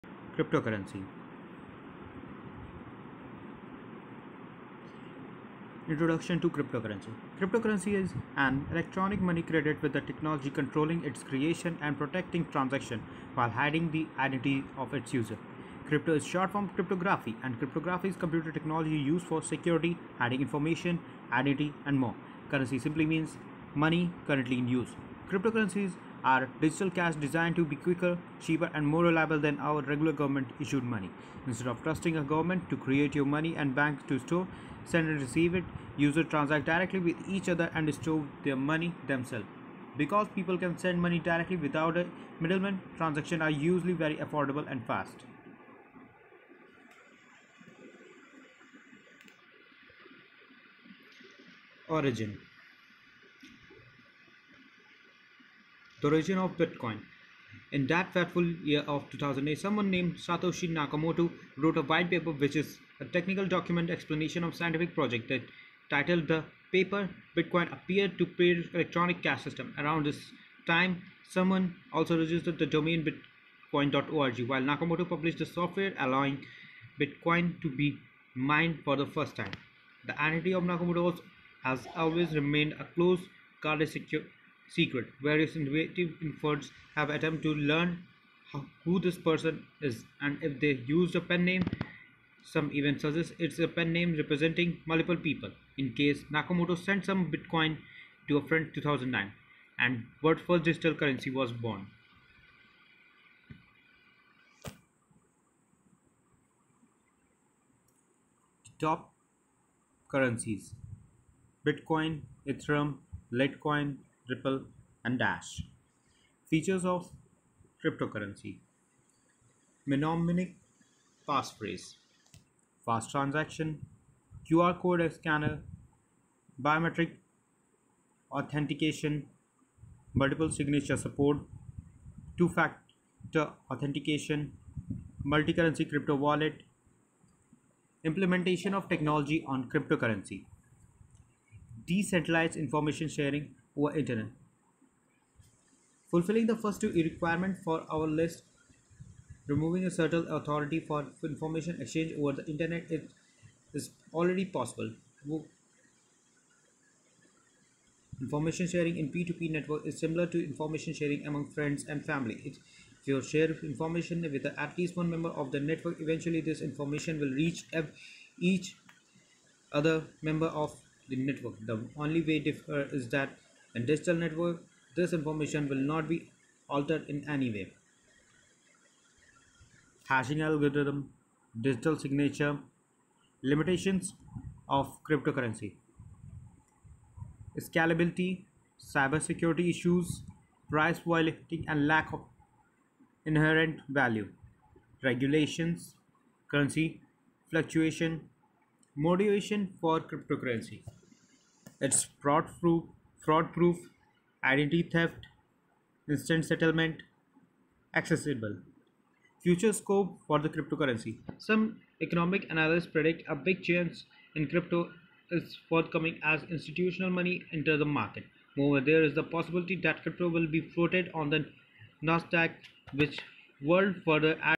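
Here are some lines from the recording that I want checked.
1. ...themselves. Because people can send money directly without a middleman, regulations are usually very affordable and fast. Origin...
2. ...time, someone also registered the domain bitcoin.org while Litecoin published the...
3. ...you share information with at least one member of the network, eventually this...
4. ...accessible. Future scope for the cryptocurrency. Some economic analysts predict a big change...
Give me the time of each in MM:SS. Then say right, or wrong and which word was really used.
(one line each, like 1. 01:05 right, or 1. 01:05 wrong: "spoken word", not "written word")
1. 00:39 wrong: "transactions", not "regulations"
2. 01:10 wrong: "Nakamoto", not "Litecoin"
3. 02:43 right
4. 03:27 right.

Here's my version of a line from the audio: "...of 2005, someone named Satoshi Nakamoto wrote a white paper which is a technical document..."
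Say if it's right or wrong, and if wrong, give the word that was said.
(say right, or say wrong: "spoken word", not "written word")
wrong: "2008", not "2005".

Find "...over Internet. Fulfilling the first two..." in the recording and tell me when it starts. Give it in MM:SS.
02:23.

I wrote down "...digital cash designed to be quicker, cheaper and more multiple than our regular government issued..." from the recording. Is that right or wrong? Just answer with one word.
wrong.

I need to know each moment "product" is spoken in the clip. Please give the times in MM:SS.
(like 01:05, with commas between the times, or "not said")
not said.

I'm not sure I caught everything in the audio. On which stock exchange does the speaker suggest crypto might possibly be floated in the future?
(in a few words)
Nasdaq.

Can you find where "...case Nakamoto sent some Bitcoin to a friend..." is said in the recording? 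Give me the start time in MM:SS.
01:35.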